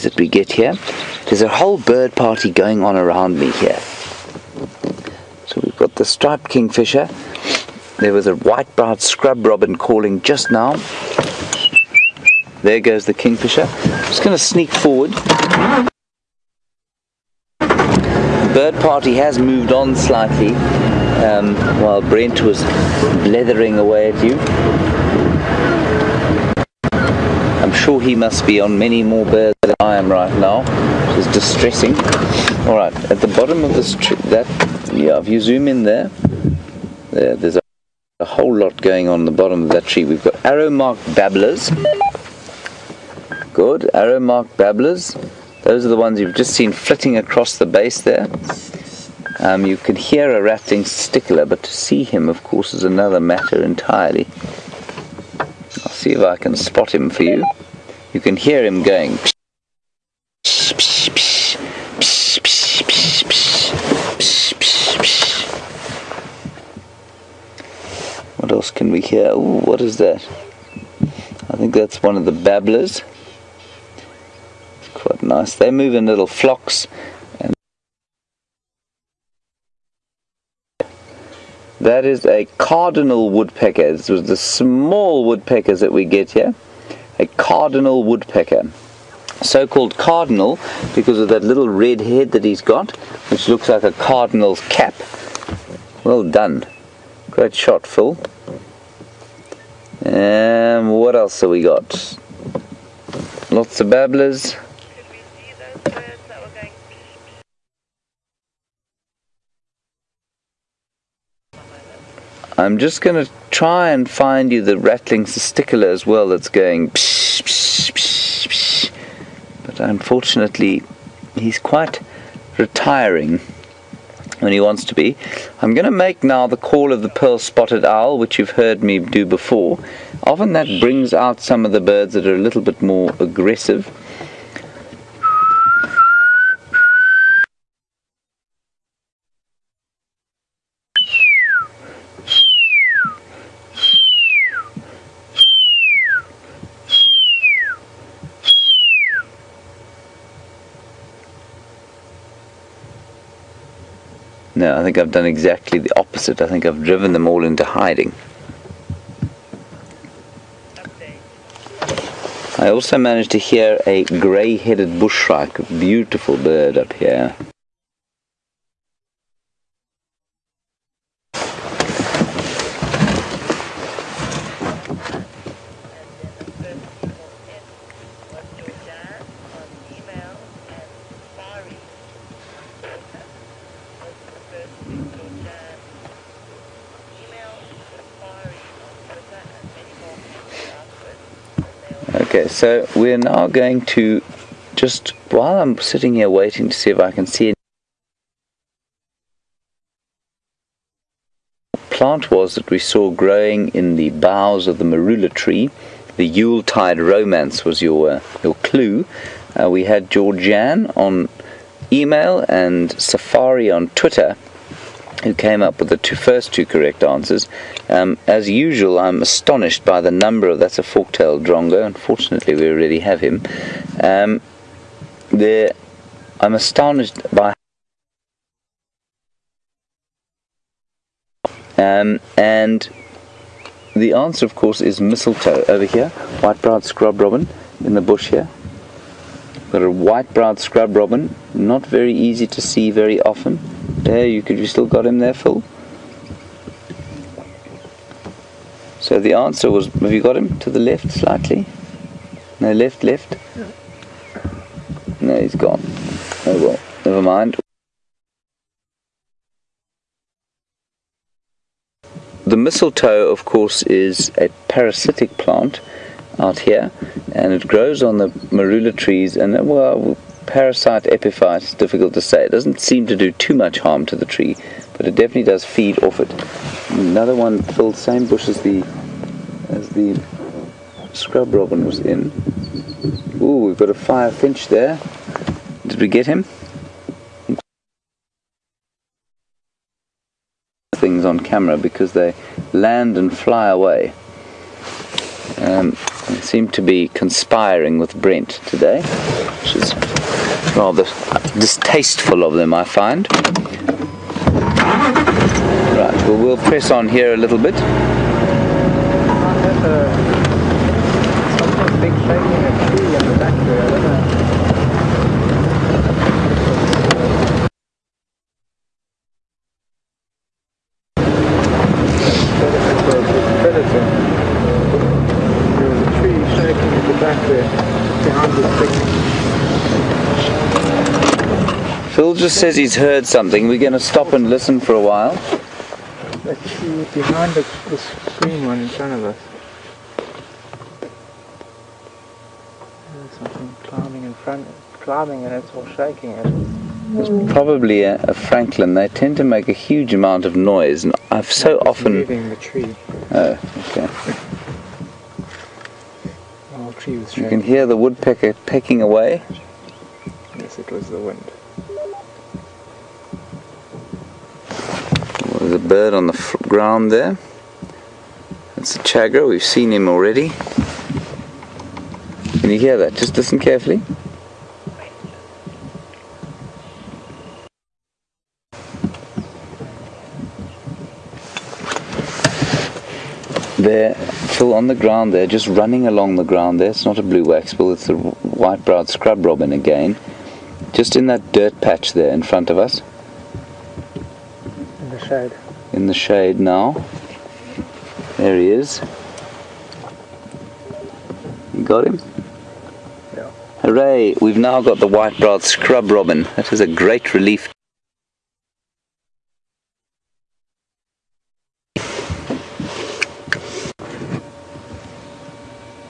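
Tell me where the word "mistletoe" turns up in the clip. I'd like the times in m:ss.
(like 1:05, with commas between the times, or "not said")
3:54, 4:22.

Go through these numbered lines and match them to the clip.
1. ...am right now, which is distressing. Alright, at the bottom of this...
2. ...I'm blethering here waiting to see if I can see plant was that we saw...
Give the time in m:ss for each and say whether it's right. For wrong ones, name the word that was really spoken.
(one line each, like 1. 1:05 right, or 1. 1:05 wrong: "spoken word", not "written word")
1. 0:29 right
2. 3:15 wrong: "sitting", not "blethering".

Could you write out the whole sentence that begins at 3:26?
The Yule Tide romance was your uh, your clue.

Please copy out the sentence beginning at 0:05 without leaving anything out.
So we've got the striped kingfisher.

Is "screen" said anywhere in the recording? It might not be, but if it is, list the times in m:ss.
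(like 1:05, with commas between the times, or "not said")
5:37.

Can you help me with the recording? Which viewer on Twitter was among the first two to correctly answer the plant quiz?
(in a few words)
Safari.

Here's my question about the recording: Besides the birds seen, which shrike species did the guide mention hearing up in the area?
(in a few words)
Grey-headed bushshrike.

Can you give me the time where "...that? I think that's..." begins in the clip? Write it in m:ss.
1:09.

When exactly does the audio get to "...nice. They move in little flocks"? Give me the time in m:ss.
1:15.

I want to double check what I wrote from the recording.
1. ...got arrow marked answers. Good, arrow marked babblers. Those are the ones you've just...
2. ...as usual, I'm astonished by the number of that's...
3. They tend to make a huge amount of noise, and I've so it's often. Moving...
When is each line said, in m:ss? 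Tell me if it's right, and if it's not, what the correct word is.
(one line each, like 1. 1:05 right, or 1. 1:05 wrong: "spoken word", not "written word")
1. 0:40 wrong: "babblers", not "answers"
2. 3:38 right
3. 5:48 right.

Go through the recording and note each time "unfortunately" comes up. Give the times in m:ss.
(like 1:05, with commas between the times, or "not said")
1:59, 3:41.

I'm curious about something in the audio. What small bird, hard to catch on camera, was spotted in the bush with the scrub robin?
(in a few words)
Fire finch.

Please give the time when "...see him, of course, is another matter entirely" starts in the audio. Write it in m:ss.
0:51.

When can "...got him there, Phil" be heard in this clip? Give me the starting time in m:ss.
4:04.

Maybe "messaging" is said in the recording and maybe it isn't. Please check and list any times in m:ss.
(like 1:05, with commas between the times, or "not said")
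not said.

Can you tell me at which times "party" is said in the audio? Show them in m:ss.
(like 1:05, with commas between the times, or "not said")
0:02, 0:18.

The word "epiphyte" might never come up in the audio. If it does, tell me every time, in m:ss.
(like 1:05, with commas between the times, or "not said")
4:31.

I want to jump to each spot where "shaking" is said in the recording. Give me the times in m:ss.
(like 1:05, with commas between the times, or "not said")
5:45, 5:57.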